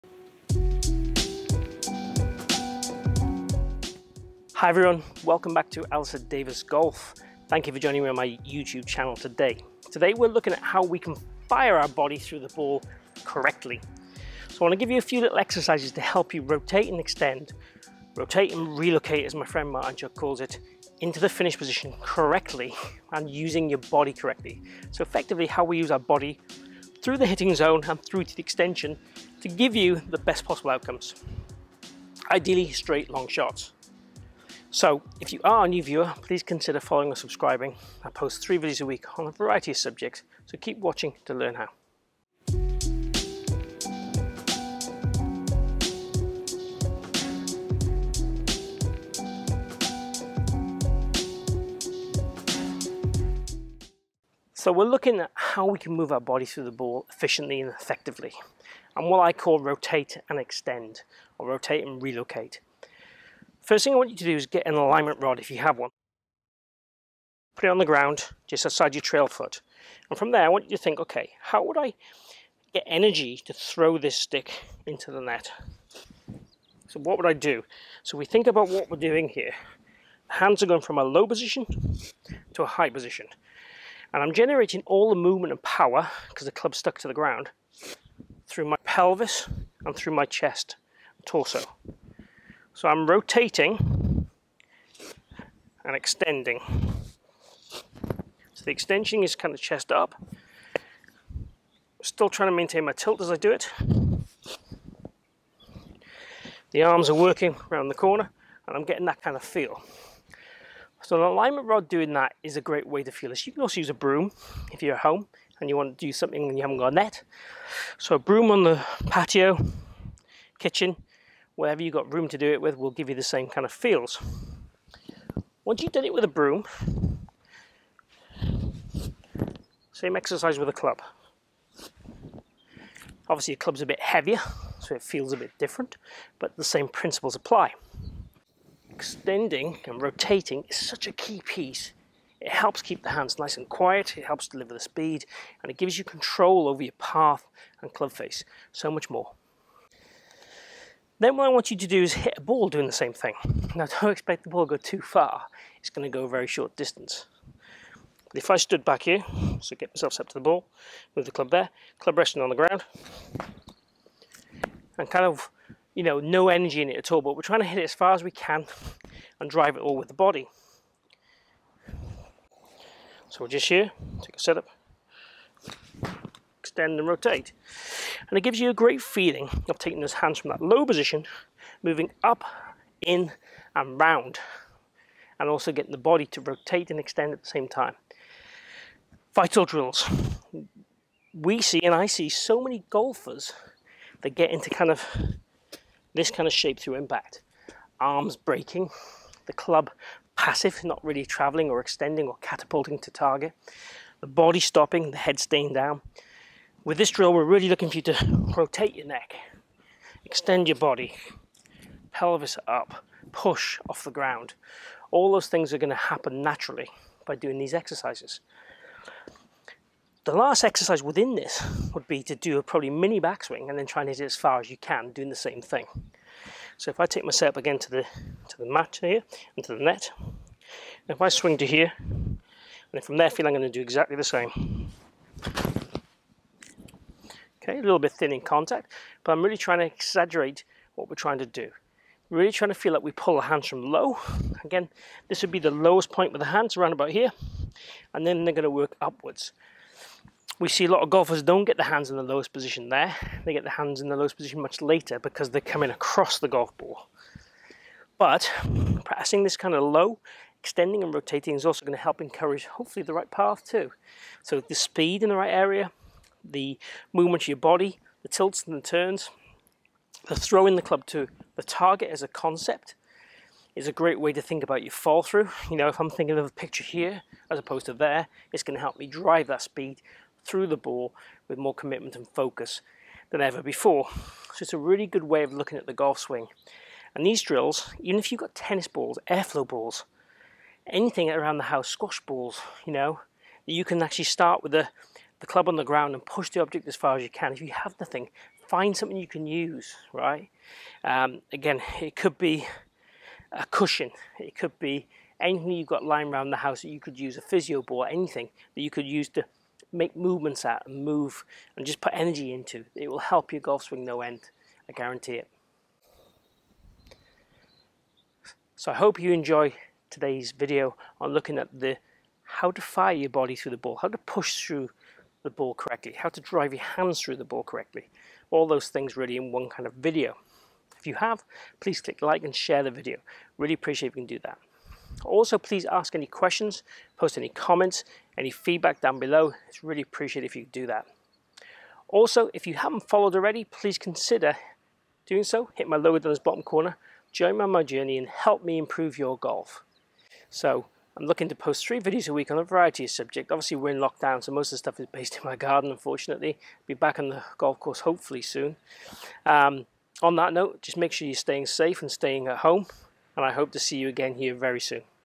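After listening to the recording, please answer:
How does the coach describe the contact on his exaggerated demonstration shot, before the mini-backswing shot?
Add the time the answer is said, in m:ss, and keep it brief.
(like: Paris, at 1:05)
a little bit thin, at 3:57.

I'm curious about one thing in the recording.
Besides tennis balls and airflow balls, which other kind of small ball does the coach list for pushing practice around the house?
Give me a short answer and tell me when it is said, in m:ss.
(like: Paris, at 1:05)
squash balls, at 4:51.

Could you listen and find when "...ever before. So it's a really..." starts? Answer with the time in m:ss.
4:43.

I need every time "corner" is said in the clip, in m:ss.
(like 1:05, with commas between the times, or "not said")
1:47, 5:46.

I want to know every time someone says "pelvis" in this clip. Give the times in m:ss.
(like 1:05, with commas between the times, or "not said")
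1:28, 3:32.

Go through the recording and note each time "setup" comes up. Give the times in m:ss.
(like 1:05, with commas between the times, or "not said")
2:54, 3:47.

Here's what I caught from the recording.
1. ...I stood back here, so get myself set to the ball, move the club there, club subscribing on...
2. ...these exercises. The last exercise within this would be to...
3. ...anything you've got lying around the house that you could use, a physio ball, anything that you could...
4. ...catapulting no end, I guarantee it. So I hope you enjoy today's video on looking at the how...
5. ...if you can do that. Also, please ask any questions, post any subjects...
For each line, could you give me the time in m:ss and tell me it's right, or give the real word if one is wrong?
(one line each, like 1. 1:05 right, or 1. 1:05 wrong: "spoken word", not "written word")
1. 2:38 wrong: "resting", not "subscribing"
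2. 3:37 right
3. 5:05 right
4. 5:13 wrong: "swing", not "catapulting"
5. 5:34 wrong: "comments", not "subjects".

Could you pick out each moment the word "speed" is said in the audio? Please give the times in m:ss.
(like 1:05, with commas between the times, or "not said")
2:24, 4:24, 4:39.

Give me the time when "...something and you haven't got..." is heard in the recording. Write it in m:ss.
1:56.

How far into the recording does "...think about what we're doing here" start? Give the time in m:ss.
1:18.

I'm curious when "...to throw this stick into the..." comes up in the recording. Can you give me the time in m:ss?
1:13.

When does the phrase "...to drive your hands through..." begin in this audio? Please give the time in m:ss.
5:26.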